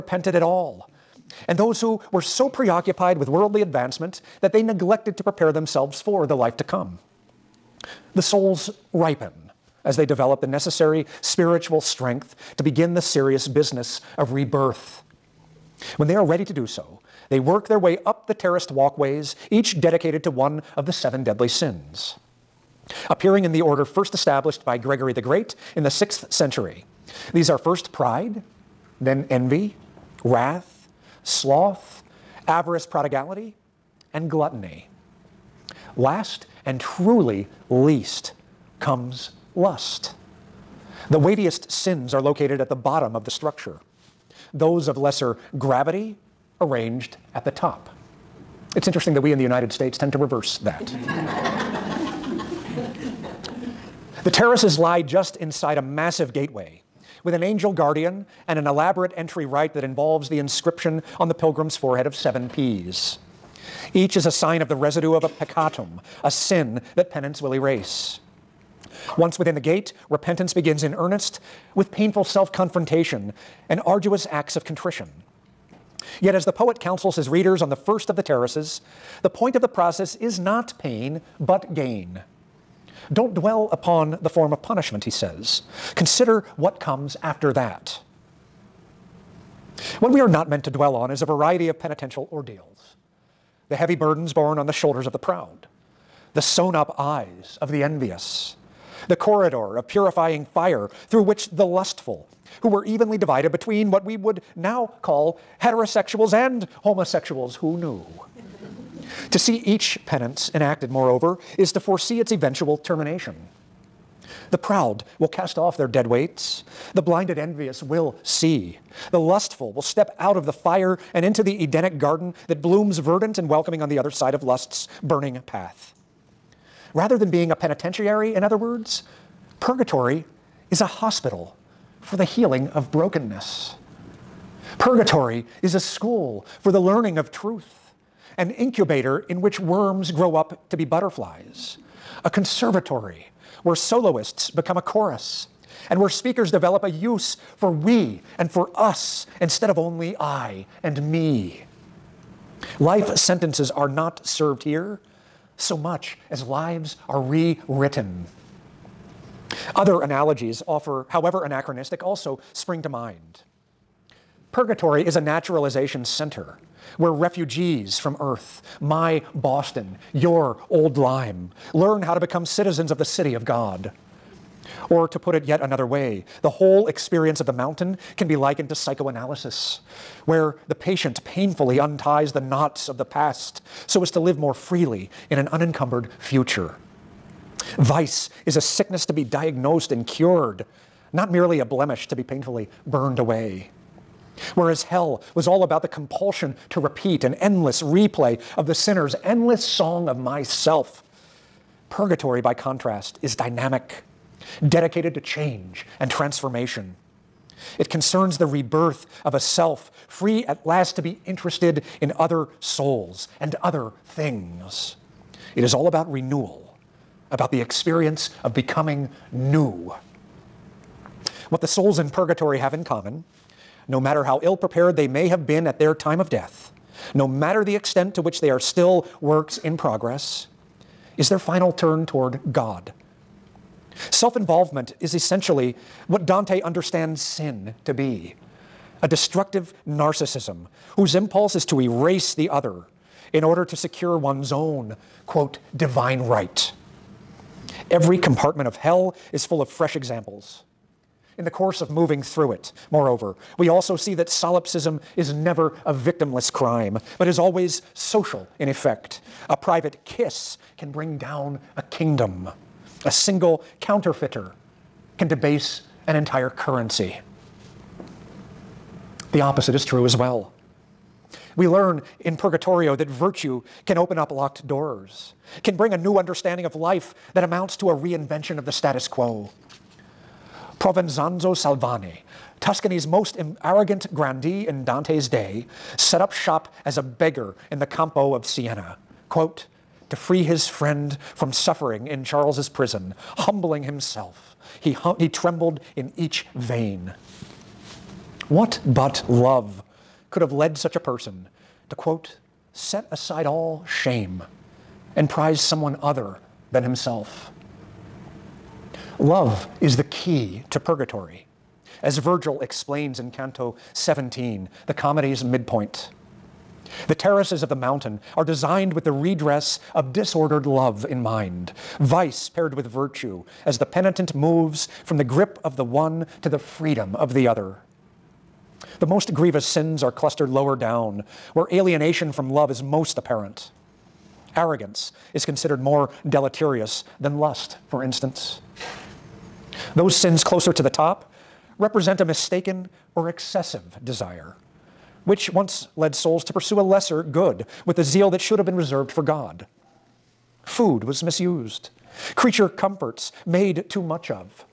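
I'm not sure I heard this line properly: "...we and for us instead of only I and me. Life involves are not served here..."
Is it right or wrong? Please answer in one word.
wrong.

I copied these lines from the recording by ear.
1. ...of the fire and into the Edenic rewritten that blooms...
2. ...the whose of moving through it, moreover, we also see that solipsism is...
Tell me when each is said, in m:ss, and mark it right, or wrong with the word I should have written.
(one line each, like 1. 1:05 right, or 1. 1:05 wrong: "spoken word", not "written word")
1. 2:00 wrong: "garden", not "rewritten"
2. 4:11 wrong: "course", not "whose".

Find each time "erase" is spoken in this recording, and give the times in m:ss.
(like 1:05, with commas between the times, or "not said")
1:07, 4:01.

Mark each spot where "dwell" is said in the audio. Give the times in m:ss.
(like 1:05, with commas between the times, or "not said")
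1:23, 1:30.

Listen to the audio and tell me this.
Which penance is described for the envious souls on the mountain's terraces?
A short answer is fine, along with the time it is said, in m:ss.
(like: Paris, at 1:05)
Sewn up eyes, at 1:36.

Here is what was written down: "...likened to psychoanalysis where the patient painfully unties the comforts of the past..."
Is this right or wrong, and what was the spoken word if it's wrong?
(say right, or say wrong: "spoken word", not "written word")
wrong: "knots", not "comforts".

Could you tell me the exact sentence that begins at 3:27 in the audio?
It concerns the rebirth of a self free at last to be interested in other souls and other things.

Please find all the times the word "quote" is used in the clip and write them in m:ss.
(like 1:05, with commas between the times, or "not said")
4:05, 4:49, 5:01.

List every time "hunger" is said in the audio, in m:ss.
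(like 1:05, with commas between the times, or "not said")
not said.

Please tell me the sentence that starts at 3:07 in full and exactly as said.
Vice is a sickness to be diagnosed and cured, not merely a blemish to be painfully burned away.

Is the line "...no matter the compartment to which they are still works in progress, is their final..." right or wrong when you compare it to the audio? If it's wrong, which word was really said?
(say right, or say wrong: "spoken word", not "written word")
wrong: "extent", not "compartment".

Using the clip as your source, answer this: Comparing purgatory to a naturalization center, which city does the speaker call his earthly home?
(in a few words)
Boston.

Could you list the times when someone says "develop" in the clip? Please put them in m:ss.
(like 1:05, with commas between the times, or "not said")
0:10, 2:26.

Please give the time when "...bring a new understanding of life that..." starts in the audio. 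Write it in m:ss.
4:35.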